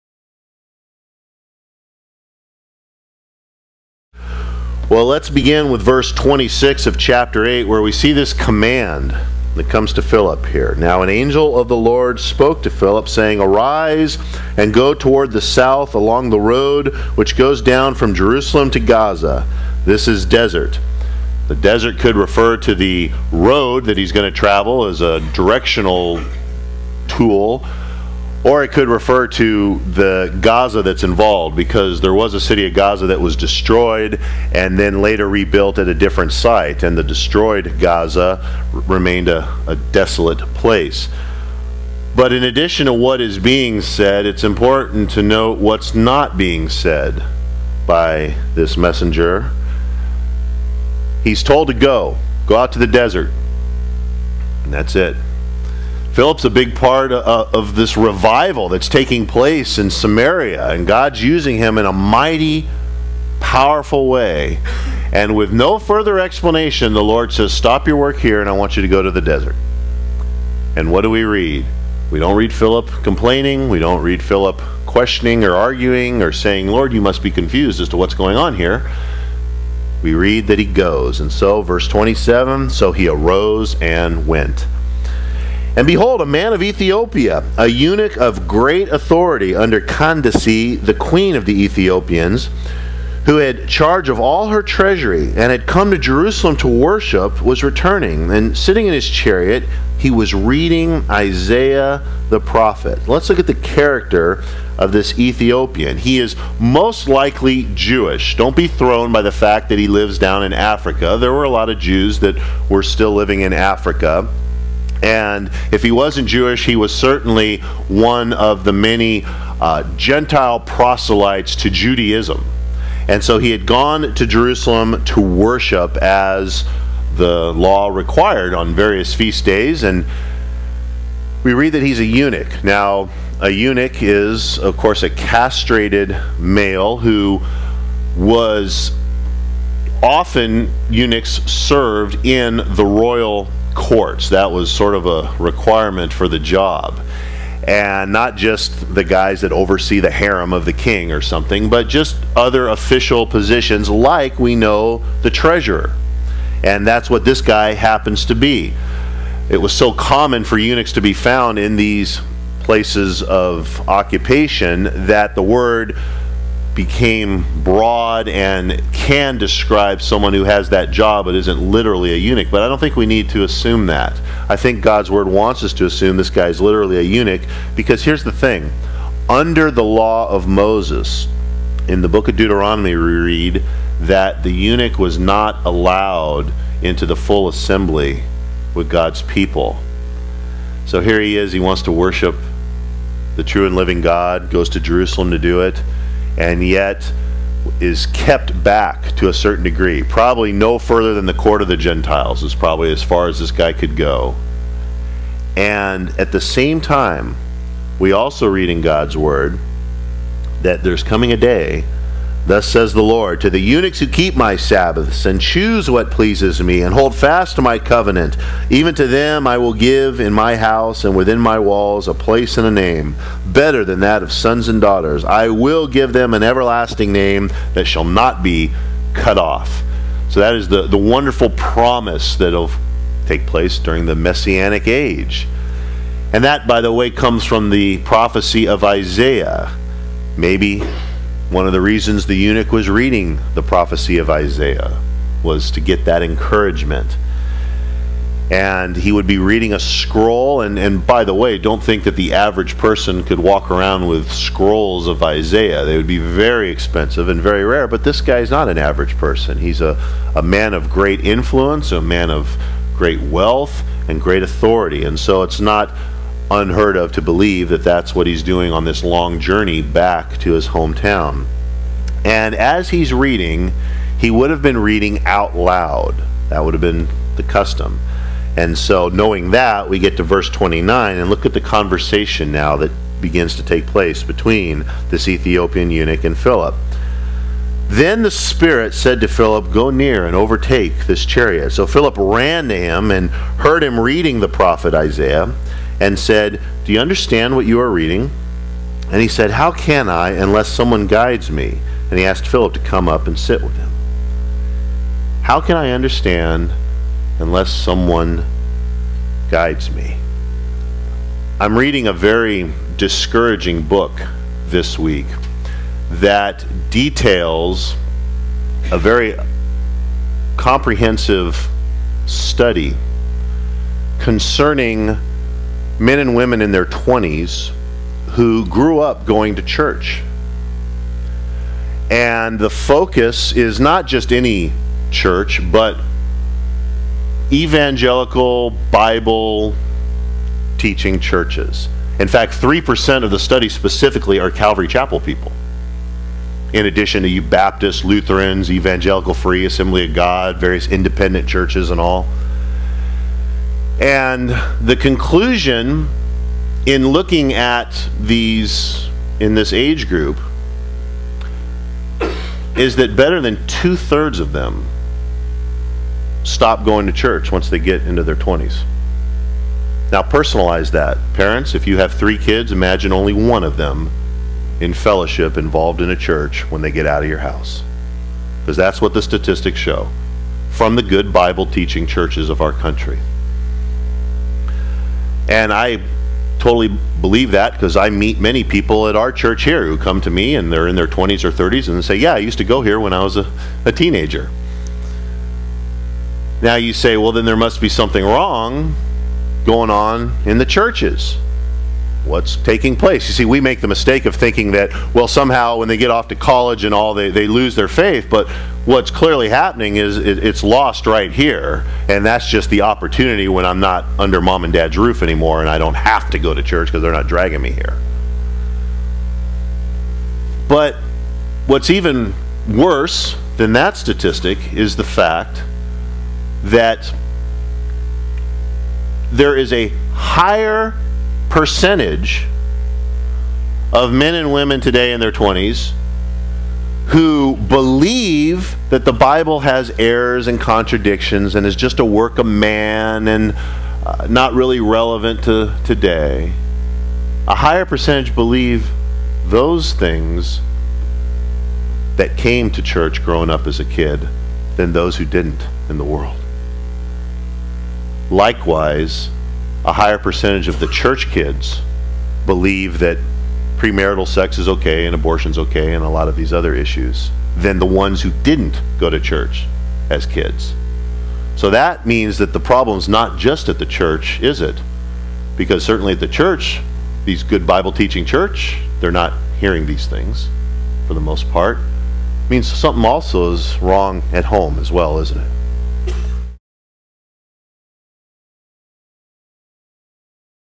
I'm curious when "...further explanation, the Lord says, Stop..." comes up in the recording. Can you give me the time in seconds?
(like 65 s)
65 s.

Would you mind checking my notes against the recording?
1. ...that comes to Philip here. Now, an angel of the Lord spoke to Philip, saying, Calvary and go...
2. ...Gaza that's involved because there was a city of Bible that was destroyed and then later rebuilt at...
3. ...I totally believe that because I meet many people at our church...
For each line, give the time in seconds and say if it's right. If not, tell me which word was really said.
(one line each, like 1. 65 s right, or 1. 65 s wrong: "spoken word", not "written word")
1. 9 s wrong: "Arise", not "Calvary"
2. 30 s wrong: "Gaza", not "Bible"
3. 385 s right.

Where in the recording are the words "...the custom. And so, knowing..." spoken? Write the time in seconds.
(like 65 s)
277 s.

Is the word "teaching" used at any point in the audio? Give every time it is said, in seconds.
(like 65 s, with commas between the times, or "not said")
340 s, 381 s, 477 s.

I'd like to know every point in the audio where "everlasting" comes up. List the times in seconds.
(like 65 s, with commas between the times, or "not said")
226 s.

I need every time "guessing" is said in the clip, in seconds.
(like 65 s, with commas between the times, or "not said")
not said.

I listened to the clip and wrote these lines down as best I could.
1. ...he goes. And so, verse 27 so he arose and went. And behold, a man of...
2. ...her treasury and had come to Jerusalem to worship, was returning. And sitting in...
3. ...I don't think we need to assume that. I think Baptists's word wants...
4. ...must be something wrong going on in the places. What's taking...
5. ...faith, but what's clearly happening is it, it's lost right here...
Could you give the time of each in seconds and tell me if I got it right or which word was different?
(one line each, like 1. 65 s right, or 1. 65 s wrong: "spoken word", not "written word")
1. 80 s right
2. 94 s right
3. 172 s wrong: "God", not "Baptists"
4. 397 s wrong: "churches", not "places"
5. 407 s right.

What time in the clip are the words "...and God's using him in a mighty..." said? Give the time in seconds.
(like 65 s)
60 s.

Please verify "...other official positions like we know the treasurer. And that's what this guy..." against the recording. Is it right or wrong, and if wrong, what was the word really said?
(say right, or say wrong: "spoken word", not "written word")
right.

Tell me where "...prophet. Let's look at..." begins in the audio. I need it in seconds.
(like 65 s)
102 s.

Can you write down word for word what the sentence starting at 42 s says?
But in addition to what is being said, it's important to note what's not being said by this messenger.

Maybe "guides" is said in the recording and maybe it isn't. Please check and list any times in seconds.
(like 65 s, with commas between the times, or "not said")
301 s, 309 s.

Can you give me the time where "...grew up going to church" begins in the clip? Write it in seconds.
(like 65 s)
328 s.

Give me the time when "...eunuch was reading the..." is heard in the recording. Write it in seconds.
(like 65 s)
242 s.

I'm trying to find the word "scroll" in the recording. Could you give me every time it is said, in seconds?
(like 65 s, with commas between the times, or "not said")
249 s, 254 s.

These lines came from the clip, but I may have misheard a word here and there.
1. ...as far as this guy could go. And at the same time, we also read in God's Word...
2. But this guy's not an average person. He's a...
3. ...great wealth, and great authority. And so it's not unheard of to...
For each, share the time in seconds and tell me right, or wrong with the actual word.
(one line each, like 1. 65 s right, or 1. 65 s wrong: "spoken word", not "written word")
1. 202 s right
2. 257 s right
3. 262 s right.